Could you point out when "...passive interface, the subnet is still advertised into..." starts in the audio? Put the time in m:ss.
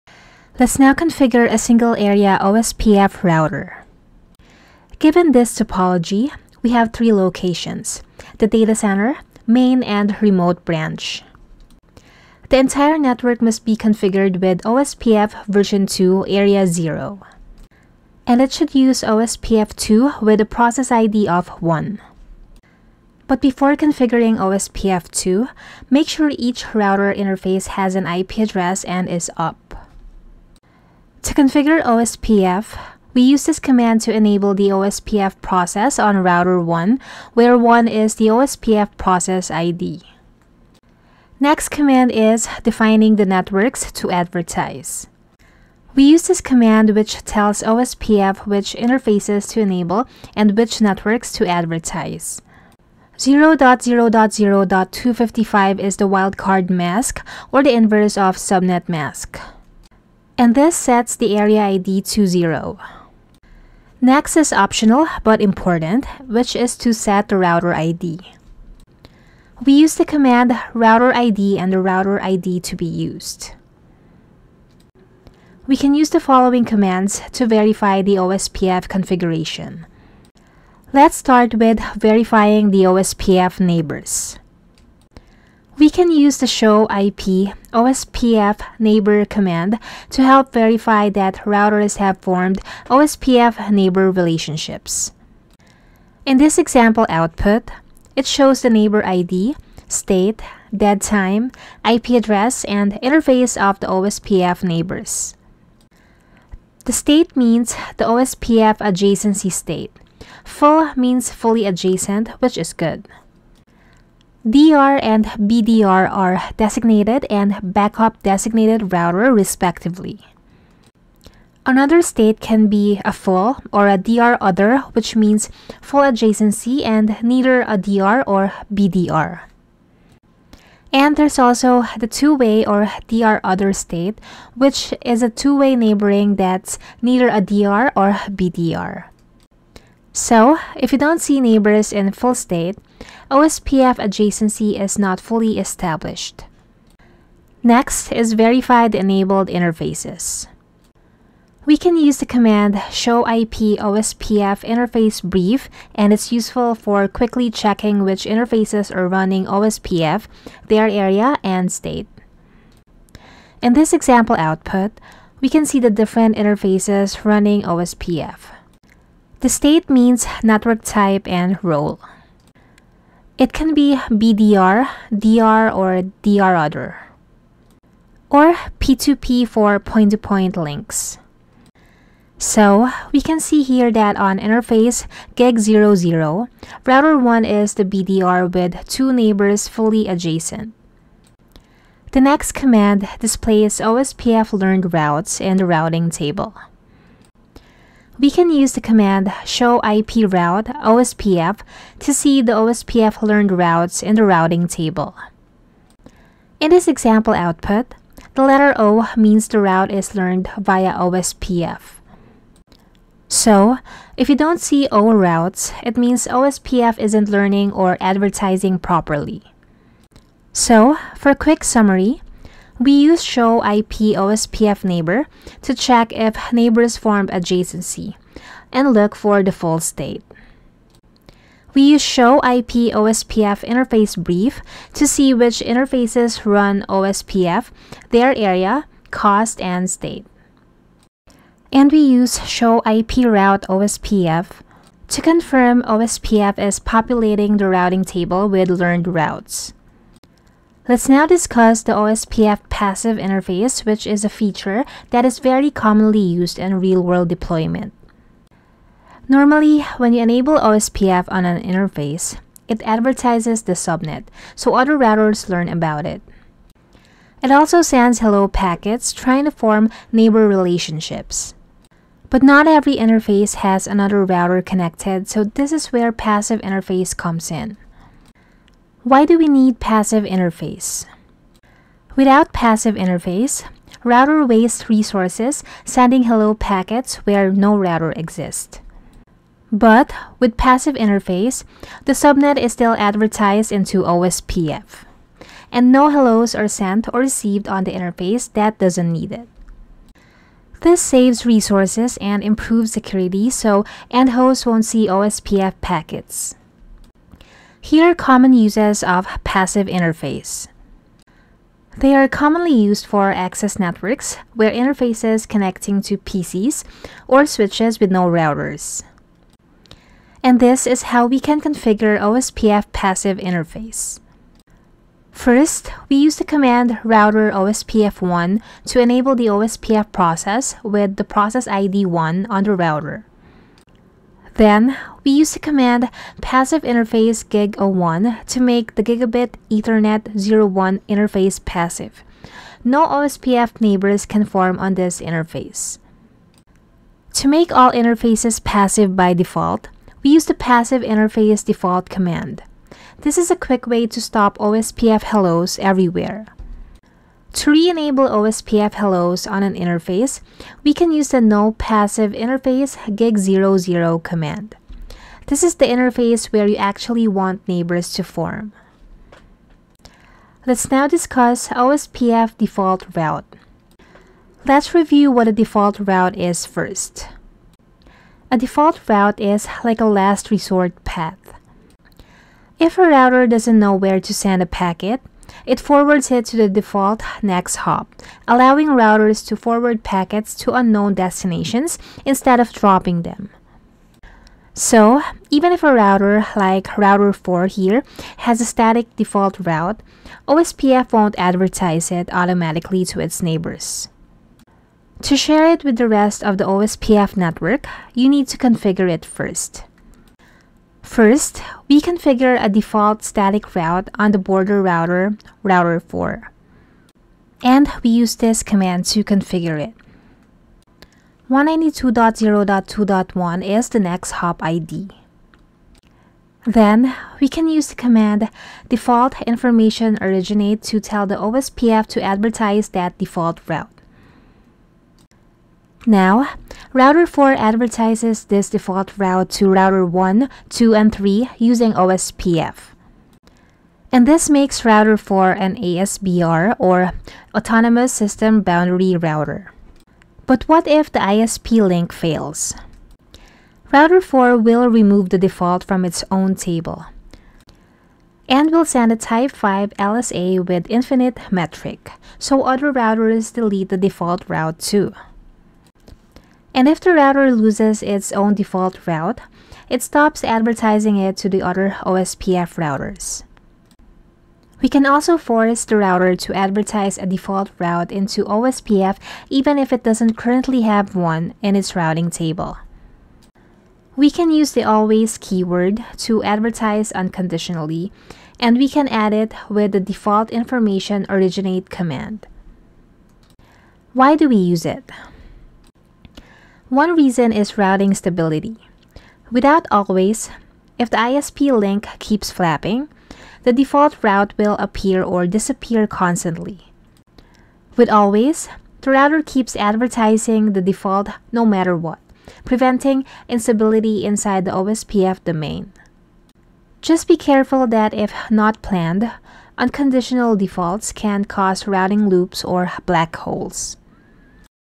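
4:50.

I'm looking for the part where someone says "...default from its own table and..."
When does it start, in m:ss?
7:35.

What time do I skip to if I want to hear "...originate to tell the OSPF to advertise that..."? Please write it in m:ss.
7:10.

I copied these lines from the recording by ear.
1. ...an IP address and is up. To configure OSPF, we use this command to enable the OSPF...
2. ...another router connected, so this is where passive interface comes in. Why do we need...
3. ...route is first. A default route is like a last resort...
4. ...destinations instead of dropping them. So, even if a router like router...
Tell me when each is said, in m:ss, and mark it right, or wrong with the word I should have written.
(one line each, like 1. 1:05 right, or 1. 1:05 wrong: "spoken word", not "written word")
1. 0:27 right
2. 4:33 right
3. 6:15 right
4. 6:31 right.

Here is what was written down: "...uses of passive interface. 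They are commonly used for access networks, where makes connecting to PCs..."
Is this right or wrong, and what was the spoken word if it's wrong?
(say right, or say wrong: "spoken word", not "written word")
wrong: "interfaces", not "makes".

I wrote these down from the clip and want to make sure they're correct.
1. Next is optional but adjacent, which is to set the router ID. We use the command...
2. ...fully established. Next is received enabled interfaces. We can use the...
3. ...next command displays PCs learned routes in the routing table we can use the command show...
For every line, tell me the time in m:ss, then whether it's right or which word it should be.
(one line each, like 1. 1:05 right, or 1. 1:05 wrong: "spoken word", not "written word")
1. 1:04 wrong: "important", not "adjacent"
2. 2:25 wrong: "verified", not "received"
3. 3:12 wrong: "OSPF", not "PCs".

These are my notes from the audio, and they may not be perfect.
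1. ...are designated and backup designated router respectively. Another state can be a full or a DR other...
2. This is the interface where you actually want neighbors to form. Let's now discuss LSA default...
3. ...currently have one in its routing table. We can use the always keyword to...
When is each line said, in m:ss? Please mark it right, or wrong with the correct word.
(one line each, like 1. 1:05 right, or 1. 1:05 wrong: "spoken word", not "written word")
1. 1:56 right
2. 6:05 wrong: "OSPF", not "LSA"
3. 8:00 right.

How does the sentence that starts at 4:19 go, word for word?
Normally, when you enable OSPF on an interface, it advertises the subnet, so other routers learn about it.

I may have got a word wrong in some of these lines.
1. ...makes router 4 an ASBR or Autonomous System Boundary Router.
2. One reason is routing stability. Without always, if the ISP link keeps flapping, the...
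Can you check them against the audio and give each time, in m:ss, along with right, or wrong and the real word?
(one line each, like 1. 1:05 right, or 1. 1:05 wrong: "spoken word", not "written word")
1. 7:24 right
2. 8:16 right.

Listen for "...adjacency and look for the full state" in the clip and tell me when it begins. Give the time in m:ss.
3:47.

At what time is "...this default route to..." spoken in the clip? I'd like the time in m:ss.
7:18.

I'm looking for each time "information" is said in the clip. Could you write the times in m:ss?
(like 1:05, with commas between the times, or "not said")
7:09, 8:10.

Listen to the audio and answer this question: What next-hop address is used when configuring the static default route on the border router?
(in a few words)
192.0.2.1.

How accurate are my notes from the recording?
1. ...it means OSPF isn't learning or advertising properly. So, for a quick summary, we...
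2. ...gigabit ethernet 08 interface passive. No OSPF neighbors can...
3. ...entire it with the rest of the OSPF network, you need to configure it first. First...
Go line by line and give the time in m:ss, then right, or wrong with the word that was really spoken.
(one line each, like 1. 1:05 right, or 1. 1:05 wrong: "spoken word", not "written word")
1. 3:35 right
2. 5:39 wrong: "01", not "08"
3. 6:45 wrong: "share", not "entire".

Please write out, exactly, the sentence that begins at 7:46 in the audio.
And if the router loses its own default route, it stops advertising it to the other OSPF routers.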